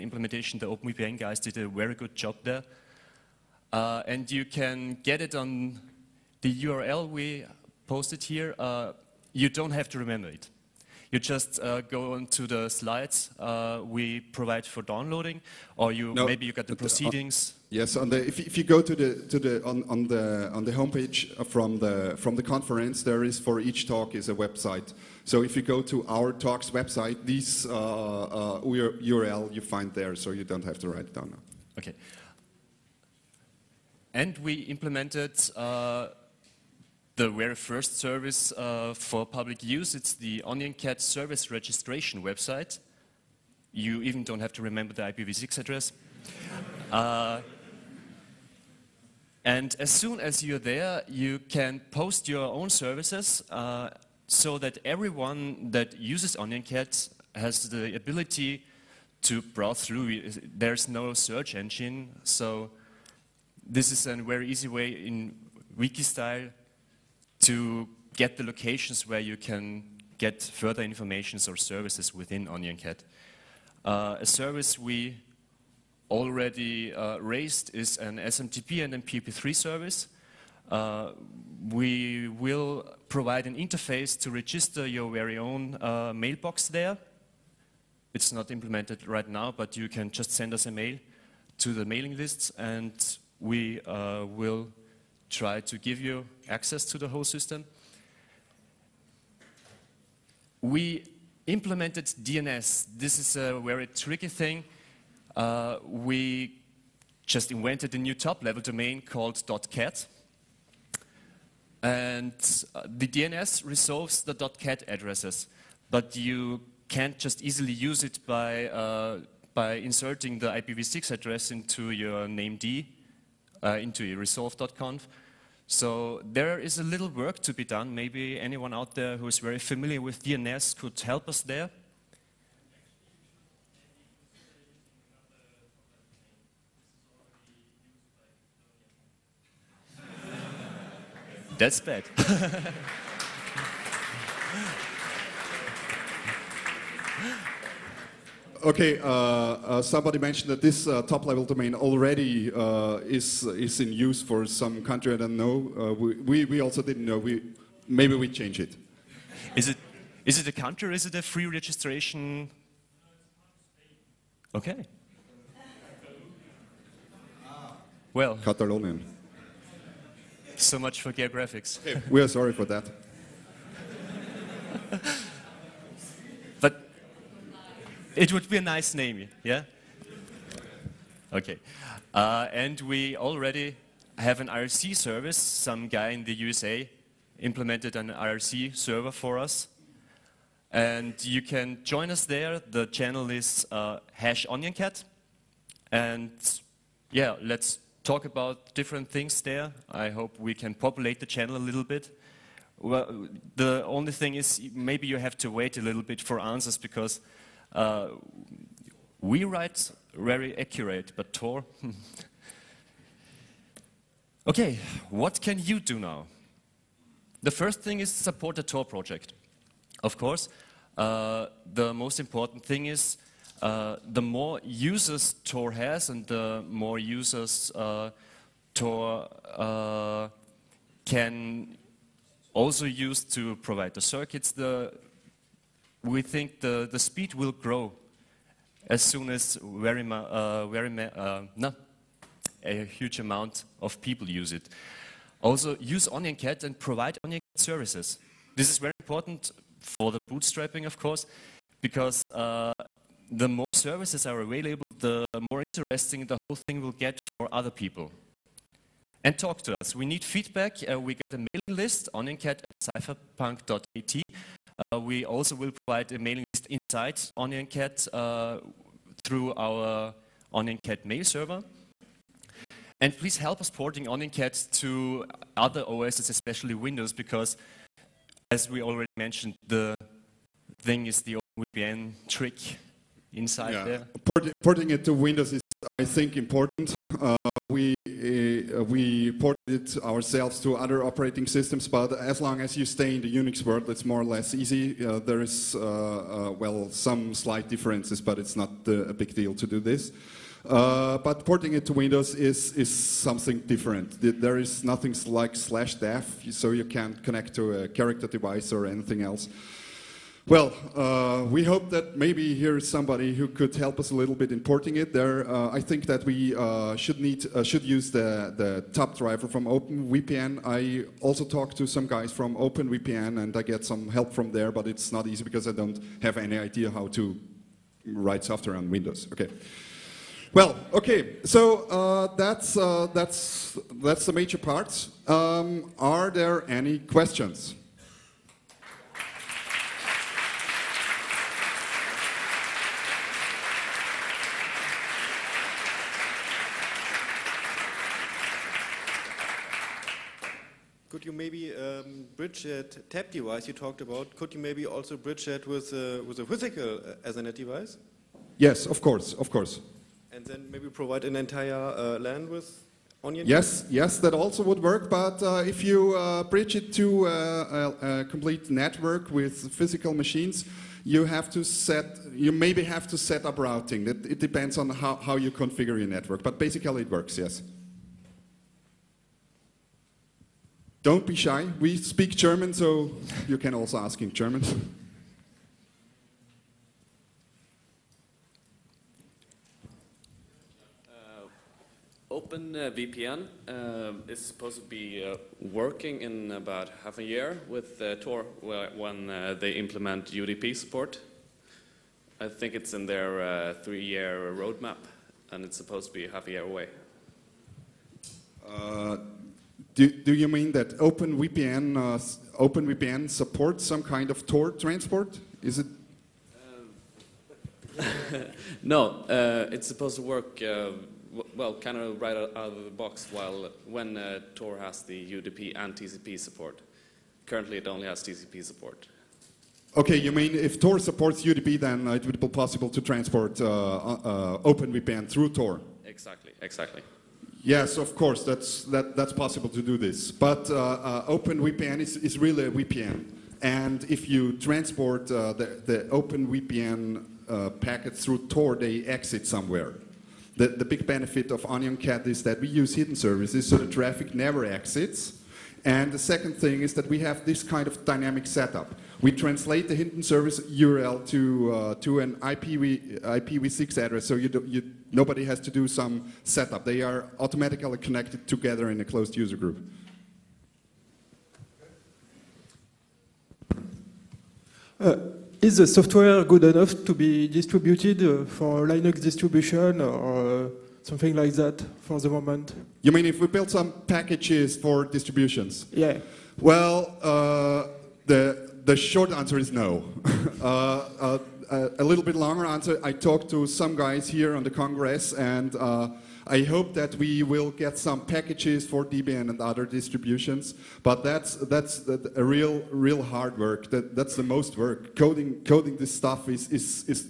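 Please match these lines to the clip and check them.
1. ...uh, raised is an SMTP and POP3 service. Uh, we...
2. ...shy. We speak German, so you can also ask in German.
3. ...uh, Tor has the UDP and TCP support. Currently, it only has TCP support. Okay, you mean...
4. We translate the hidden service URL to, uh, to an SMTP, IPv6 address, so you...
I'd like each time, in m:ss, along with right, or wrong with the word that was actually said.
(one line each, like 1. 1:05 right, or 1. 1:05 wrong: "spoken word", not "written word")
1. 1:16 right
2. 6:21 right
3. 7:04 right
4. 7:39 wrong: "IPv", not "SMTP".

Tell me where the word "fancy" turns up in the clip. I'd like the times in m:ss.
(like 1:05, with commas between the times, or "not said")
not said.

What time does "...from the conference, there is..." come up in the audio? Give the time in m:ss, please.
0:22.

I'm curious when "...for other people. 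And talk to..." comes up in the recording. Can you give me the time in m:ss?
4:17.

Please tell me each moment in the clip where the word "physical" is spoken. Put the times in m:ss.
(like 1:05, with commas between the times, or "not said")
5:56, 6:09.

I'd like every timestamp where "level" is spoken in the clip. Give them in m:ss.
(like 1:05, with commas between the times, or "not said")
1:48, 2:31.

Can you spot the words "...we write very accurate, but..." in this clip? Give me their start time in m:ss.
3:29.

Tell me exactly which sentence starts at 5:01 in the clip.
but porting it to Windows is, is something different.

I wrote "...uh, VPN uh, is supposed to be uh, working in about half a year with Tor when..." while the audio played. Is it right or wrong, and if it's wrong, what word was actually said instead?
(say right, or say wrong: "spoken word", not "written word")
right.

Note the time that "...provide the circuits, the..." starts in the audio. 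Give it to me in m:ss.
3:53.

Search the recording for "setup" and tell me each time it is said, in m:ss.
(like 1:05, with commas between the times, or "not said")
7:38, 7:46.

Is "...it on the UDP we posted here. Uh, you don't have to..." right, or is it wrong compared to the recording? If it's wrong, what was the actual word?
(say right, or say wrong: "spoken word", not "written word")
wrong: "URL", not "UDP".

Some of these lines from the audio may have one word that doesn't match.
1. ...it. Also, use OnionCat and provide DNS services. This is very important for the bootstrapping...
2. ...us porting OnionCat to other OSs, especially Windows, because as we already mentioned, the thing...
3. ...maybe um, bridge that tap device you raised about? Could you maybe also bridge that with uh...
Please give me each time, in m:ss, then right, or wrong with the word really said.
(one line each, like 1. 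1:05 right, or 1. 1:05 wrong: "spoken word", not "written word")
1. 4:04 wrong: "OnionCat", not "DNS"
2. 4:33 right
3. 5:51 wrong: "talked", not "raised".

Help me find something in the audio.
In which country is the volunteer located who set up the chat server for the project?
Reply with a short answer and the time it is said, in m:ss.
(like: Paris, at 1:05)
USA, at 3:06.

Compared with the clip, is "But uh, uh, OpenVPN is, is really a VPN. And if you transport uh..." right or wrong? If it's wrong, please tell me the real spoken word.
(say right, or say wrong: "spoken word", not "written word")
right.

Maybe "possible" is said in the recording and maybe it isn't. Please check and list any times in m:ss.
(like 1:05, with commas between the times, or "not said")
7:12, 7:19.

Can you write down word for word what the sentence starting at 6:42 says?
I think it's in their uh, three-year roadmap, and it's supposed to be half a year away.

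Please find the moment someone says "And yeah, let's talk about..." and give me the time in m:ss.
3:15.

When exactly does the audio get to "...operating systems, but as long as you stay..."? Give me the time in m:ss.
4:51.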